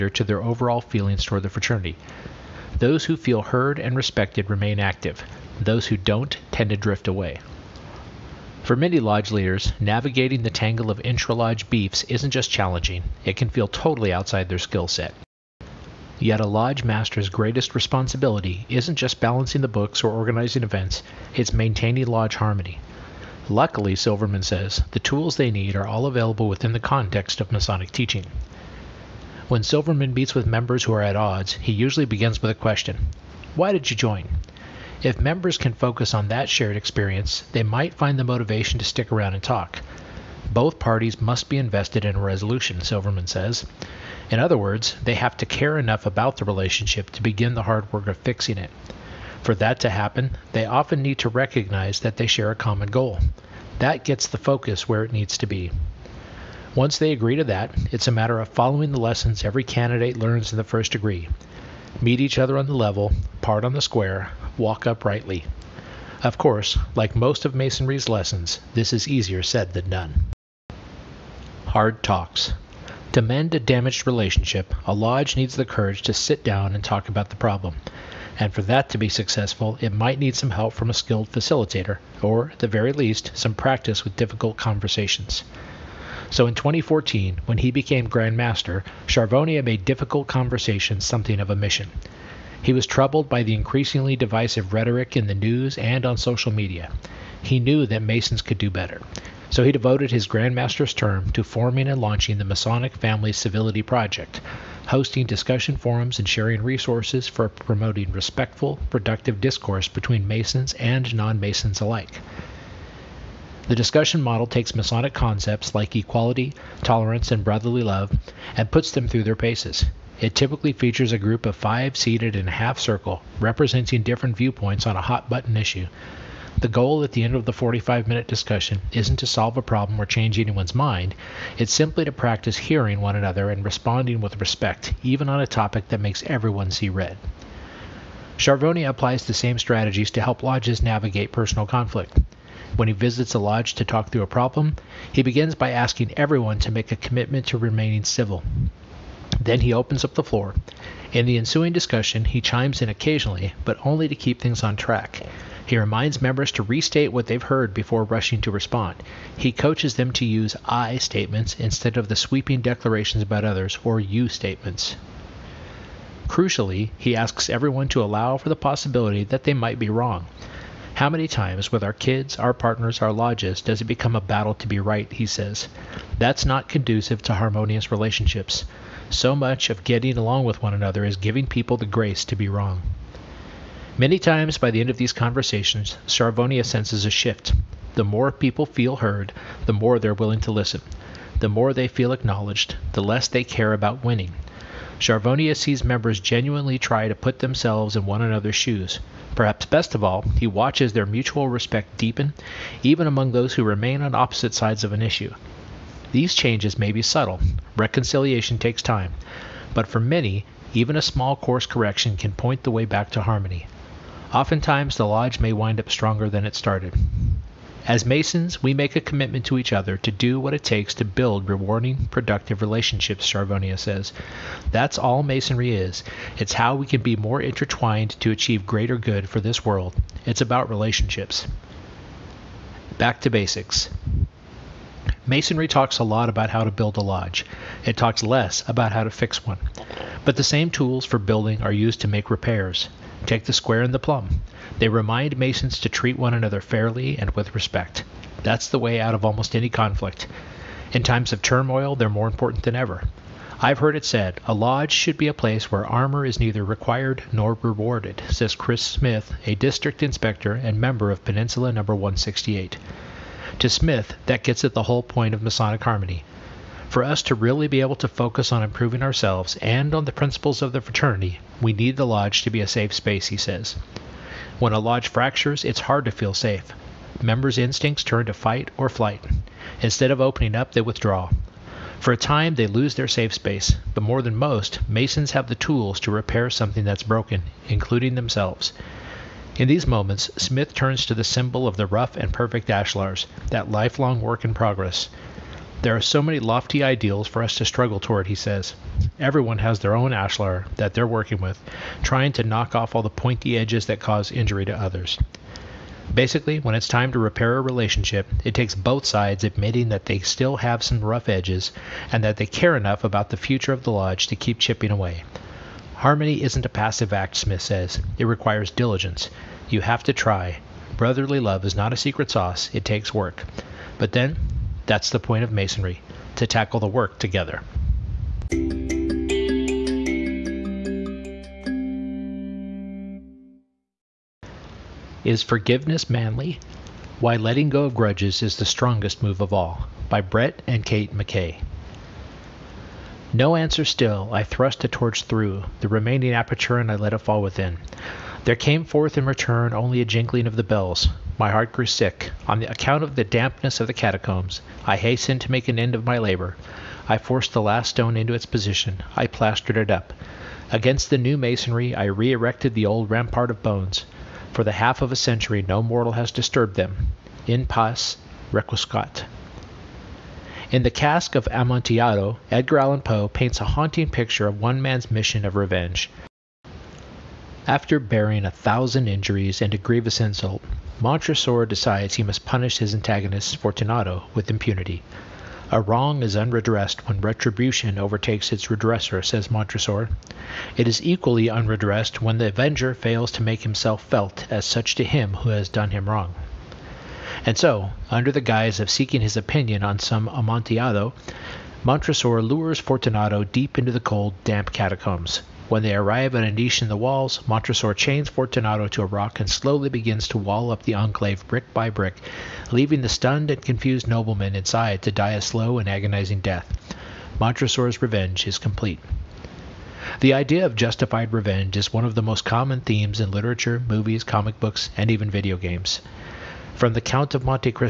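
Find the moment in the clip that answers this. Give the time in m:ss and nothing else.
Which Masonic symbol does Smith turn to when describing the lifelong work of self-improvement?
4:52.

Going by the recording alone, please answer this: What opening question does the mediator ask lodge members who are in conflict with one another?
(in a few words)
Why did you join?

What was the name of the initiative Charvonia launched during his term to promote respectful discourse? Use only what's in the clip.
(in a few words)
Masonic Family Civility Project.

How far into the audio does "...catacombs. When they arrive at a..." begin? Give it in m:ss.
6:44.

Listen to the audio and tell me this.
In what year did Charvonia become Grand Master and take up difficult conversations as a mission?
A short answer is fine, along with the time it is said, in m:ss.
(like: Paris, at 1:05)
2014, at 1:26.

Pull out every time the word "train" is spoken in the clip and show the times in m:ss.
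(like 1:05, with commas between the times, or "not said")
not said.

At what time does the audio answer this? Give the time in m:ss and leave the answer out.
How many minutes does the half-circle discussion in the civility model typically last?
2:07.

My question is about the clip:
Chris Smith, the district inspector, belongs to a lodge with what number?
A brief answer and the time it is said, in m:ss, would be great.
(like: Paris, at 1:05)
168, at 4:21.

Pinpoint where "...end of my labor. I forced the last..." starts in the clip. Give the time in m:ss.
5:55.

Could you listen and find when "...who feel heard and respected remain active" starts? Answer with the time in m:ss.
0:03.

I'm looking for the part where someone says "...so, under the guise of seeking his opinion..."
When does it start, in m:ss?
6:37.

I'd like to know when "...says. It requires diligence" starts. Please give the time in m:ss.
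5:17.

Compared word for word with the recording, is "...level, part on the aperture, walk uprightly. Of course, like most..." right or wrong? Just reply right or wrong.
wrong.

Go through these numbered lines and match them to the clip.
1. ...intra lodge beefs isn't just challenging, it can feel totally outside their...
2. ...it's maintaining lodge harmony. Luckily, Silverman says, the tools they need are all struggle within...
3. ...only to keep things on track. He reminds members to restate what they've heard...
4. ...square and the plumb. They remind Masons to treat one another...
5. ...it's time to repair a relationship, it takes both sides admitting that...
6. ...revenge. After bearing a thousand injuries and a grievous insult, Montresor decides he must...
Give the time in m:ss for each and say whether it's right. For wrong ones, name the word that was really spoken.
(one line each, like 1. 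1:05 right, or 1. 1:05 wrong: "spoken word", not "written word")
1. 0:11 right
2. 0:21 wrong: "available", not "struggle"
3. 2:33 right
4. 4:03 right
5. 5:06 right
6. 6:15 right.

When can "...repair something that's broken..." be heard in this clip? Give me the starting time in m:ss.
4:46.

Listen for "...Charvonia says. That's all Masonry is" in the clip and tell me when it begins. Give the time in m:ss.
3:43.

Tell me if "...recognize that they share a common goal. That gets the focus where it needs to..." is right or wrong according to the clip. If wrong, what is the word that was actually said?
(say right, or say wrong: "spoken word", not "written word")
right.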